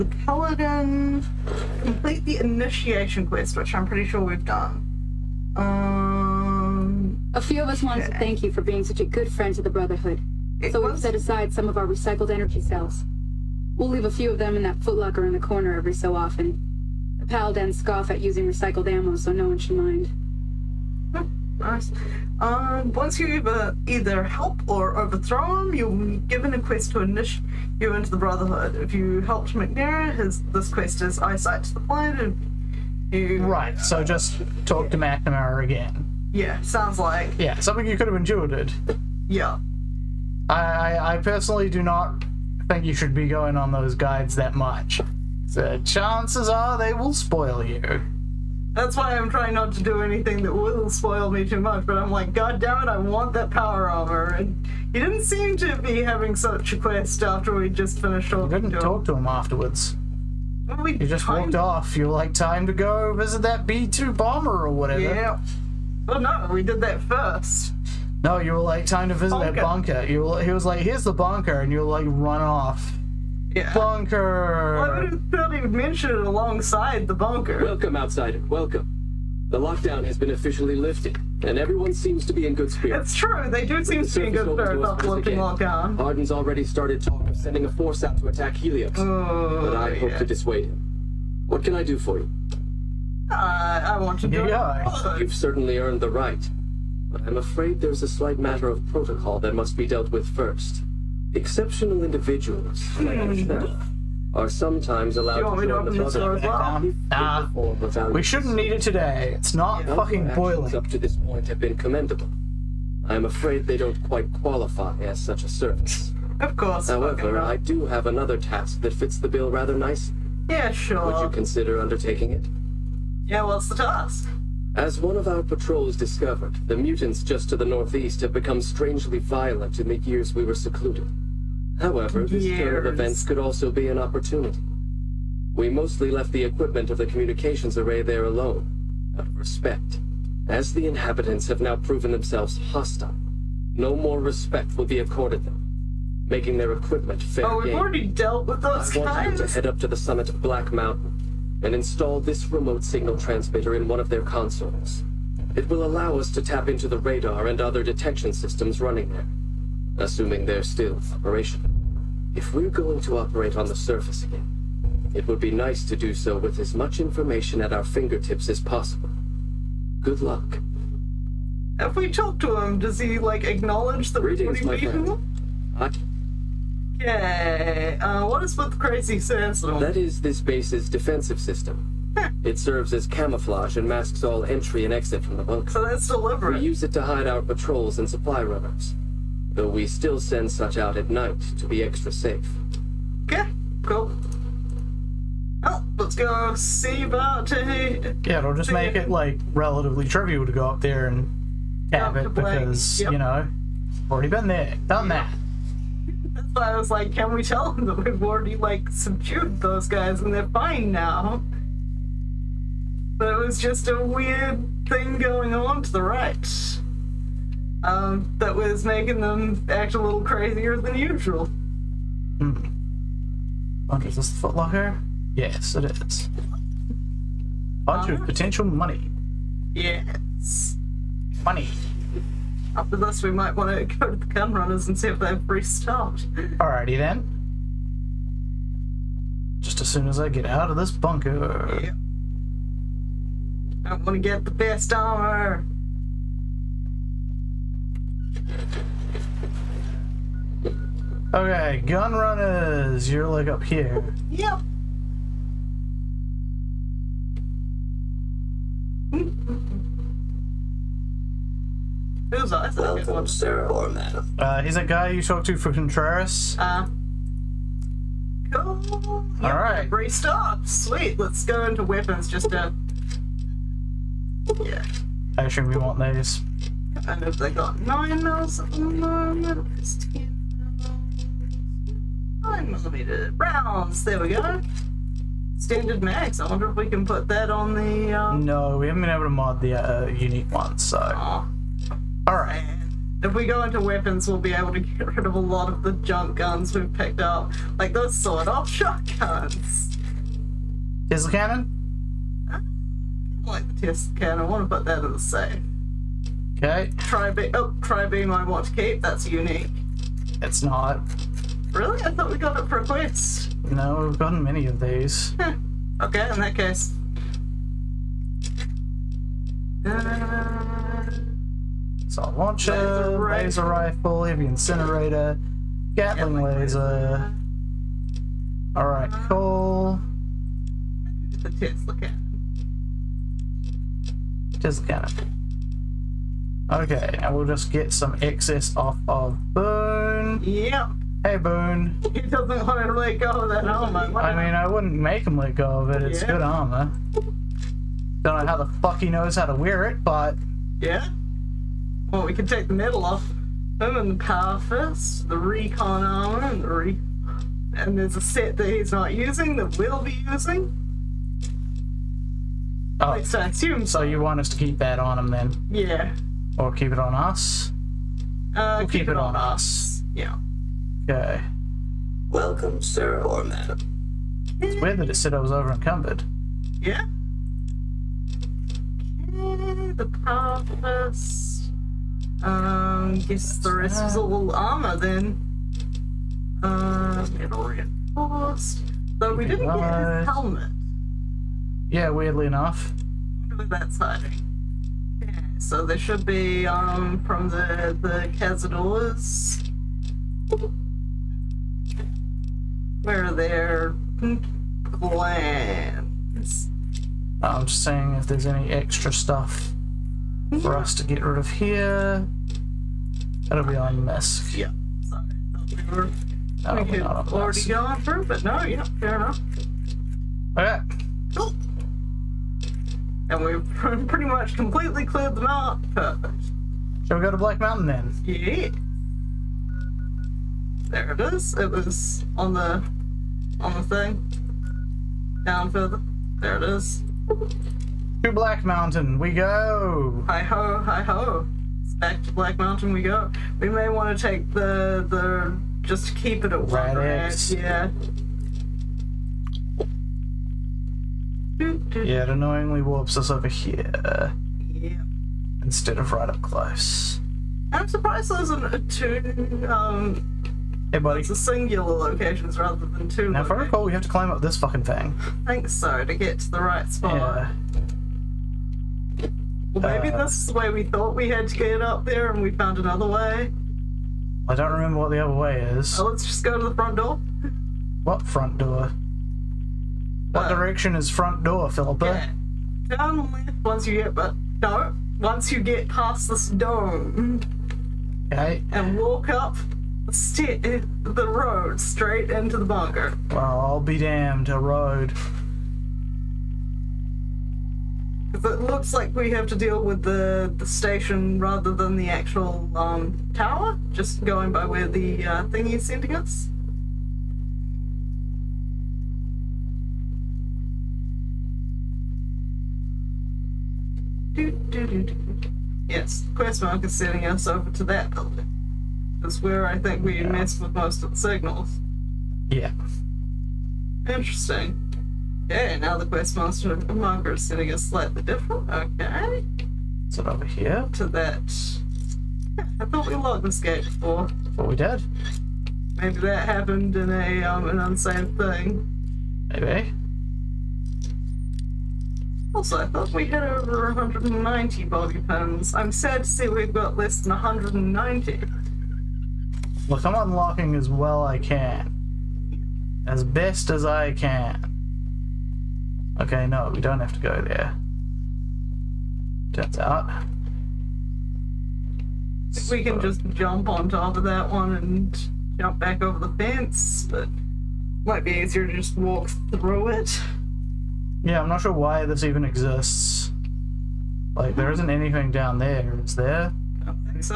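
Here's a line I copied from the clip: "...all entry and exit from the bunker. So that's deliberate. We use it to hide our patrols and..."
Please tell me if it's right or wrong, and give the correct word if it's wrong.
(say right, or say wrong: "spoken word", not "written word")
right.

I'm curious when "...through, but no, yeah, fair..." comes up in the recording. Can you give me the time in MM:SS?
06:58.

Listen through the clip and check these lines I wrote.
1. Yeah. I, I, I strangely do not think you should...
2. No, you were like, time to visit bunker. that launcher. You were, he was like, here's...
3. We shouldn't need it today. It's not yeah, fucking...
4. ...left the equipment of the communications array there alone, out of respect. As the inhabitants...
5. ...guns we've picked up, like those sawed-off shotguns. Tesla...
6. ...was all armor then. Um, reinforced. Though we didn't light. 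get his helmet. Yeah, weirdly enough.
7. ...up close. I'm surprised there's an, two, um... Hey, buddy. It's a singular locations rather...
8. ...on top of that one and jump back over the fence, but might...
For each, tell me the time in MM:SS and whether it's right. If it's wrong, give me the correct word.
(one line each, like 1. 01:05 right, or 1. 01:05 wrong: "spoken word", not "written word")
1. 00:39 wrong: "personally", not "strangely"
2. 01:08 wrong: "bunker", not "launcher"
3. 01:48 right
4. 02:16 right
5. 04:56 right
6. 06:24 right
7. 07:36 right
8. 09:23 right.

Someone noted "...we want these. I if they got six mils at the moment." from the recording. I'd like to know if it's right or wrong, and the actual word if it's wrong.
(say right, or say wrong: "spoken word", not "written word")
wrong: "nine", not "six".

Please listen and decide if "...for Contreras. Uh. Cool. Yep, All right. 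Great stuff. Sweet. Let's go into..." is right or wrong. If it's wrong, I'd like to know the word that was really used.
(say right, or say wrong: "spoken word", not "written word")
right.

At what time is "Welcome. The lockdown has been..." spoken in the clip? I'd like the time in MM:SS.
01:18.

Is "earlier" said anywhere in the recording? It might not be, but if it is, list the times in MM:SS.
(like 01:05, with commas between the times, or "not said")
not said.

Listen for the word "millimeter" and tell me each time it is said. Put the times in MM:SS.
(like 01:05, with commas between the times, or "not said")
04:42.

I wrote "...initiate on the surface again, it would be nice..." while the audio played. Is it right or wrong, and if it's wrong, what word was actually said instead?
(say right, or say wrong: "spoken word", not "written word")
wrong: "operate", not "initiate".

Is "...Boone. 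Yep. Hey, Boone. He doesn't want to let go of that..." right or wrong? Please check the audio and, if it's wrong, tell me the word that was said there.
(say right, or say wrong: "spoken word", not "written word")
right.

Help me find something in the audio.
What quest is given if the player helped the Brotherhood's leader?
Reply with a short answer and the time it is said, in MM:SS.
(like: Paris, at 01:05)
Eyesight to the blind, at 00:31.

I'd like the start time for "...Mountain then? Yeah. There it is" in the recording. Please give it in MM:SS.
07:07.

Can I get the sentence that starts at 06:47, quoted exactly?
I'm just saying if there's any extra stuff for us to get rid of here, that'll be on Misc.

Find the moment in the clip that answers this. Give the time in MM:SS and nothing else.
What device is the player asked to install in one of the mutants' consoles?
02:32.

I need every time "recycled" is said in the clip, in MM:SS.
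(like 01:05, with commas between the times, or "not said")
00:11, 00:18.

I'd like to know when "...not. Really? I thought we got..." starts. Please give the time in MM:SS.
05:10.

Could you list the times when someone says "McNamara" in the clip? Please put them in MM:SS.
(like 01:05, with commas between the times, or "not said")
00:29, 00:35.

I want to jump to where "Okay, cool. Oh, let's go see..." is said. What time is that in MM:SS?
03:13.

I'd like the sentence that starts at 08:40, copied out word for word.
messed with most of the signals.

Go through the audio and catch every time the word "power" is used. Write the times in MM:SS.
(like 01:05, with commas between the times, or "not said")
00:53, 05:54.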